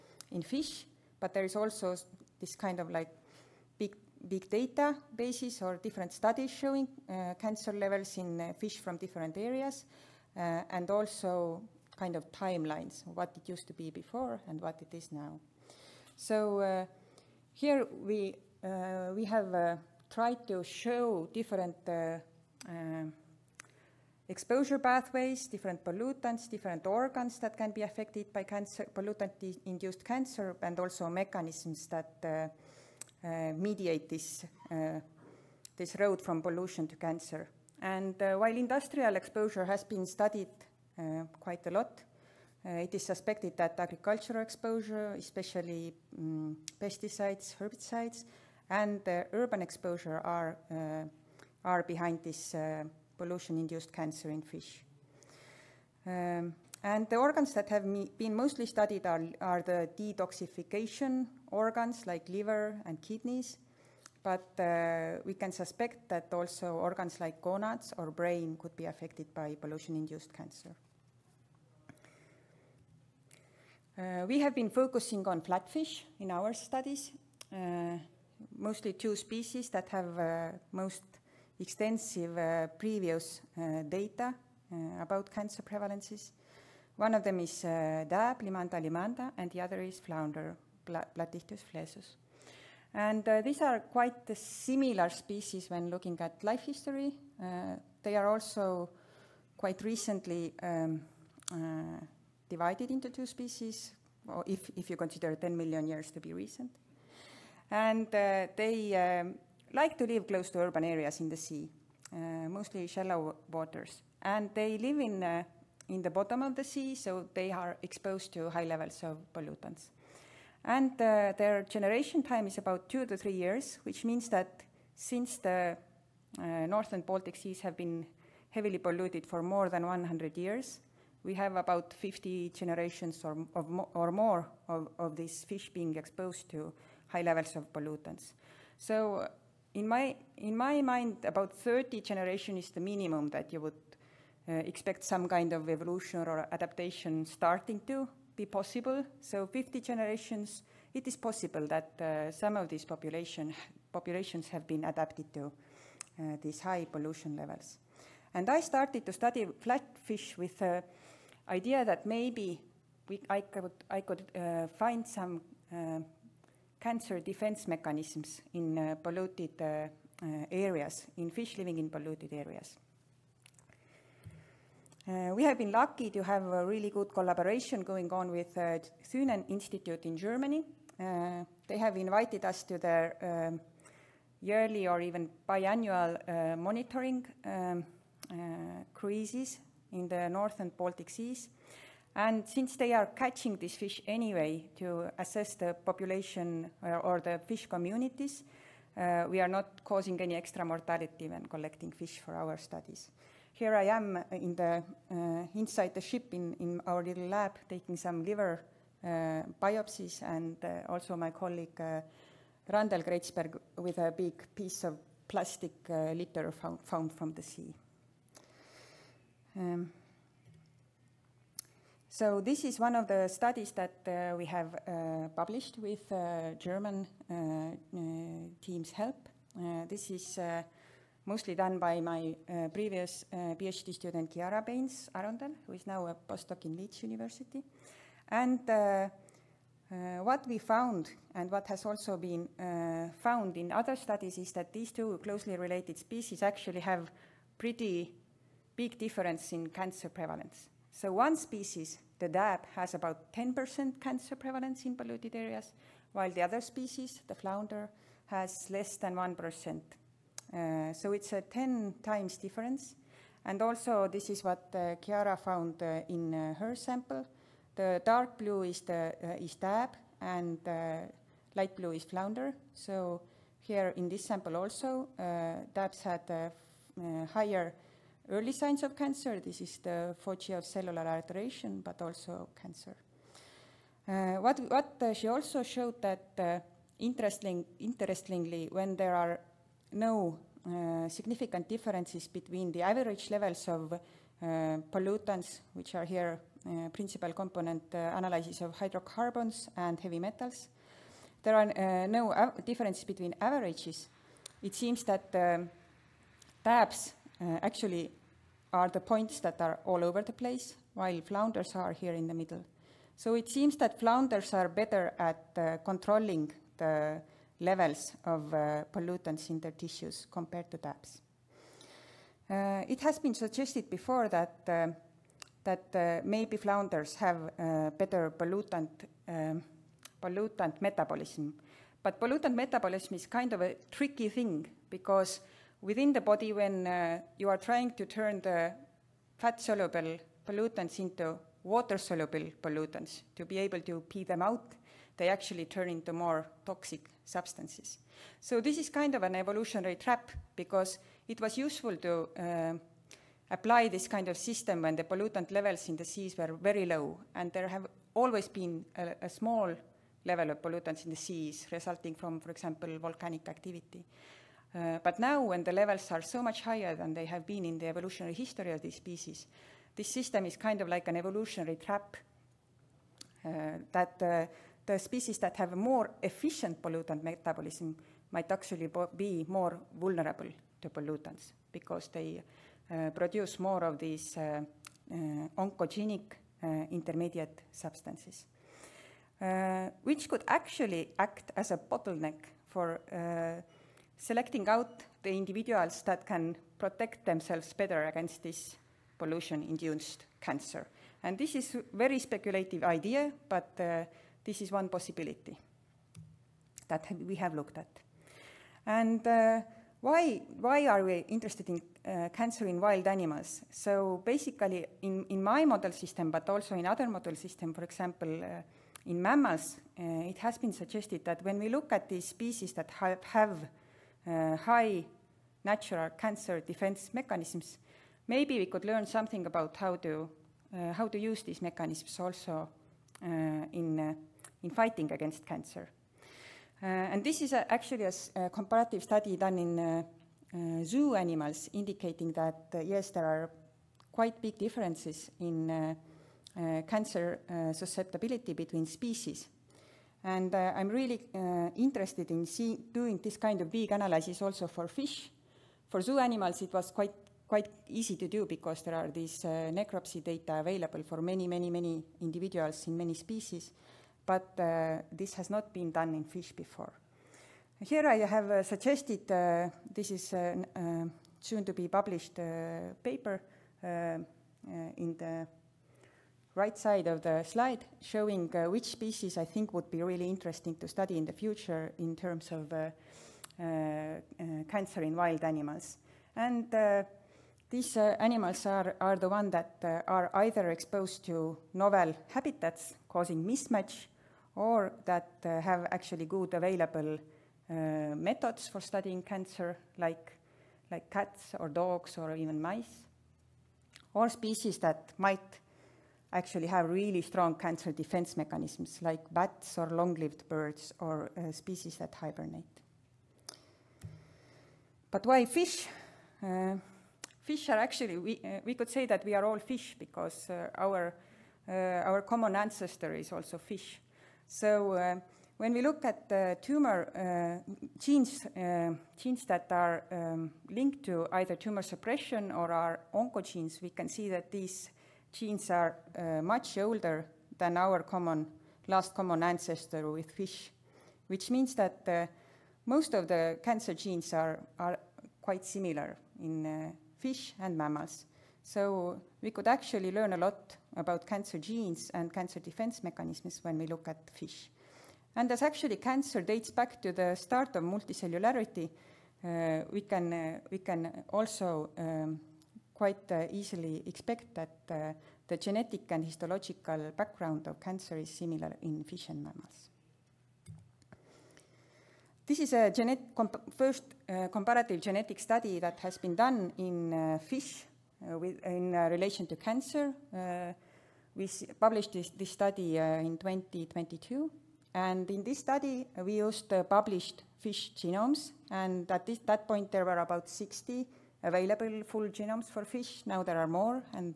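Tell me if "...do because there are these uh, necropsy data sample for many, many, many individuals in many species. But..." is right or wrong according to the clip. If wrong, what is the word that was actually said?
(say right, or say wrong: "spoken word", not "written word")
wrong: "available", not "sample".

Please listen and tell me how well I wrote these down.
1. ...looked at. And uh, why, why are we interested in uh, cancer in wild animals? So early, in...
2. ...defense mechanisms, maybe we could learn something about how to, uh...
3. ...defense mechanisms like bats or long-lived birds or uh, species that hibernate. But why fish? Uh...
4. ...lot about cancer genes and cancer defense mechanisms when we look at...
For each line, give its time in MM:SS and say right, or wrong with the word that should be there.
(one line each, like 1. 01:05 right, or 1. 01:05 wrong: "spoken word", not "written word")
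1. 06:47 wrong: "basically", not "early"
2. 07:06 right
3. 08:27 right
4. 09:10 right.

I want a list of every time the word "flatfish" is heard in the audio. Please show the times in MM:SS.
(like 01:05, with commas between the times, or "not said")
01:15, 02:39.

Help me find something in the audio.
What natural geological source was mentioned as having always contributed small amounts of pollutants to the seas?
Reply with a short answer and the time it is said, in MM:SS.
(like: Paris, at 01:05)
volcanic activity, at 06:02.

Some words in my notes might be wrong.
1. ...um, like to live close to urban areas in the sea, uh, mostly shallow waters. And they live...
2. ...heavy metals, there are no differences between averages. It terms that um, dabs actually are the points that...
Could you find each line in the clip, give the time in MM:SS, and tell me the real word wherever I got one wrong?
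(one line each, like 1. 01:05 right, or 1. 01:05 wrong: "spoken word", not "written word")
1. 01:49 right
2. 04:59 wrong: "seems", not "terms".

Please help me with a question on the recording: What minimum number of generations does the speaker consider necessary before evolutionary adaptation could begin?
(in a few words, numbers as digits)
30.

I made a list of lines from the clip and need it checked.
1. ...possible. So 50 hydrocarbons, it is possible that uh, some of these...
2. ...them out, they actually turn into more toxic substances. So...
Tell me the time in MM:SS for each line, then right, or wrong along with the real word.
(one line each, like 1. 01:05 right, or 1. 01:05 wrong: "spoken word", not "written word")
1. 02:28 wrong: "generations", not "hydrocarbons"
2. 05:44 right.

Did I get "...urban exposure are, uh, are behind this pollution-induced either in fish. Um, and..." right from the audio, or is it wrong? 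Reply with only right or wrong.
wrong.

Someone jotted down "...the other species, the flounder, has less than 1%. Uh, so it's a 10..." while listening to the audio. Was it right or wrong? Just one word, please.
right.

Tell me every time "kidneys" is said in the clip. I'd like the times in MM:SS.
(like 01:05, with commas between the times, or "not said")
01:02.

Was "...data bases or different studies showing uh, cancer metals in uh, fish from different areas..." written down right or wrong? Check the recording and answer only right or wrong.
wrong.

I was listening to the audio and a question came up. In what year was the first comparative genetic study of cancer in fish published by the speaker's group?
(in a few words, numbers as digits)
2022.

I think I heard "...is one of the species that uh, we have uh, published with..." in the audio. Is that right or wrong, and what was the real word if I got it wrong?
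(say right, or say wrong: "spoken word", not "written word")
wrong: "studies", not "species".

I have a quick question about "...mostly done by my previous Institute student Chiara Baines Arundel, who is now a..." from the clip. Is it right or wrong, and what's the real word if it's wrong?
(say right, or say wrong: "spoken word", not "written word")
wrong: "PhD", not "Institute".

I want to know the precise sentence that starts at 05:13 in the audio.
So it seems that flounders are better at uh, controlling the levels of uh, pollutants in their tissues compared to dabs.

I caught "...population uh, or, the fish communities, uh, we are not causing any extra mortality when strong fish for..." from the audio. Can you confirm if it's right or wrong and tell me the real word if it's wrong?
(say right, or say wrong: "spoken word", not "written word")
wrong: "collecting", not "strong".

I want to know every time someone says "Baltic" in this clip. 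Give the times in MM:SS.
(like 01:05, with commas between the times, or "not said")
02:07, 03:10.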